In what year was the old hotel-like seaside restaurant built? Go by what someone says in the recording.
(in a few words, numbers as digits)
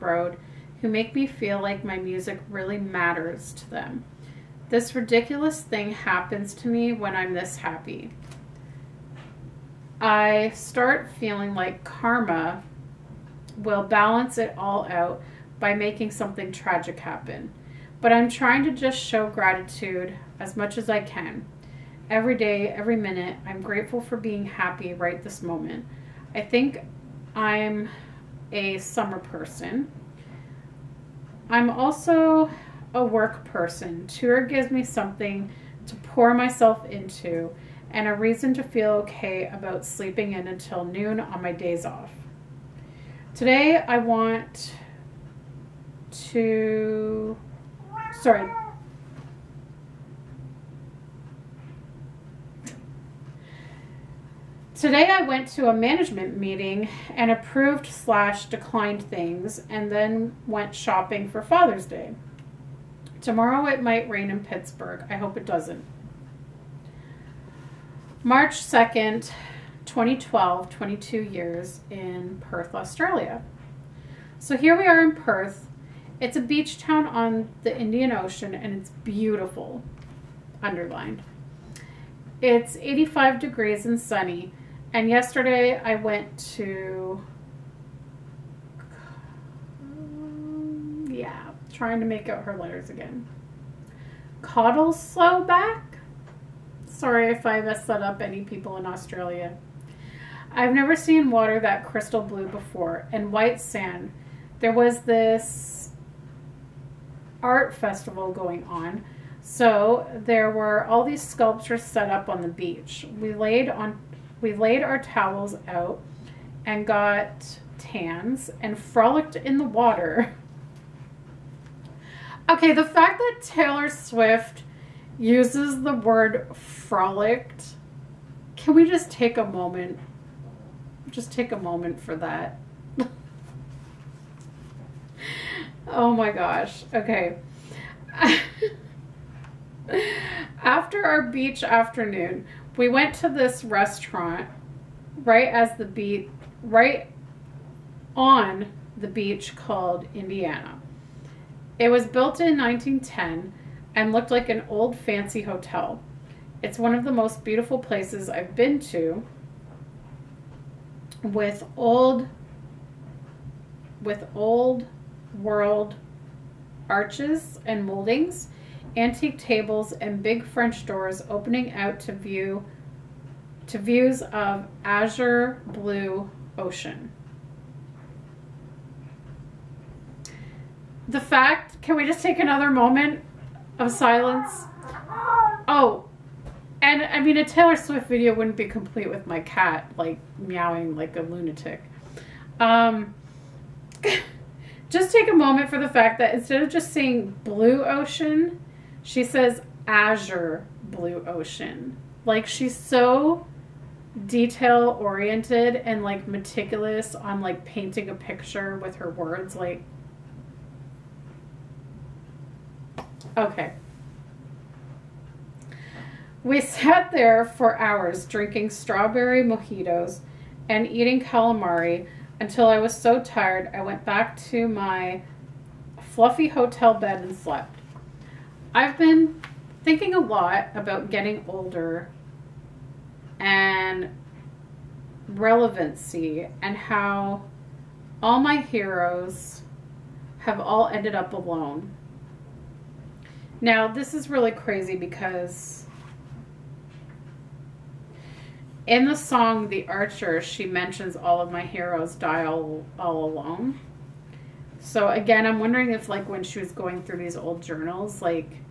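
1910.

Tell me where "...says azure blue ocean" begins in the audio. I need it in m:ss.
3:19.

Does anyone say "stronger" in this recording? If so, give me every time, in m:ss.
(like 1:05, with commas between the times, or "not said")
not said.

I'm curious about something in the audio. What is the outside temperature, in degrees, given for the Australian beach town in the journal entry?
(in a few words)
85.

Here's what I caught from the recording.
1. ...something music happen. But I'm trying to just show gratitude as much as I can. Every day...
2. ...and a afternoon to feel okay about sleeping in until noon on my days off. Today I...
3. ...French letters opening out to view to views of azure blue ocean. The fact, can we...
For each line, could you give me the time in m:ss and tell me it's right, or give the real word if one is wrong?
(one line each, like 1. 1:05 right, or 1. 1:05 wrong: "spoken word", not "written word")
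1. 0:16 wrong: "tragic", not "music"
2. 0:37 wrong: "reason", not "afternoon"
3. 2:50 wrong: "doors", not "letters".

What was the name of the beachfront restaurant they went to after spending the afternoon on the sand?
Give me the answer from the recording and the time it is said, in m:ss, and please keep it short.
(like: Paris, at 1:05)
Indiana, at 2:30.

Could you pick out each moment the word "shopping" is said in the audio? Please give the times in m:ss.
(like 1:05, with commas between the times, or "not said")
1:00.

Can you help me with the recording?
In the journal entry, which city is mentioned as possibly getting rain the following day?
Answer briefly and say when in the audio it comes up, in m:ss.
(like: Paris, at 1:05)
Pittsburgh, at 1:04.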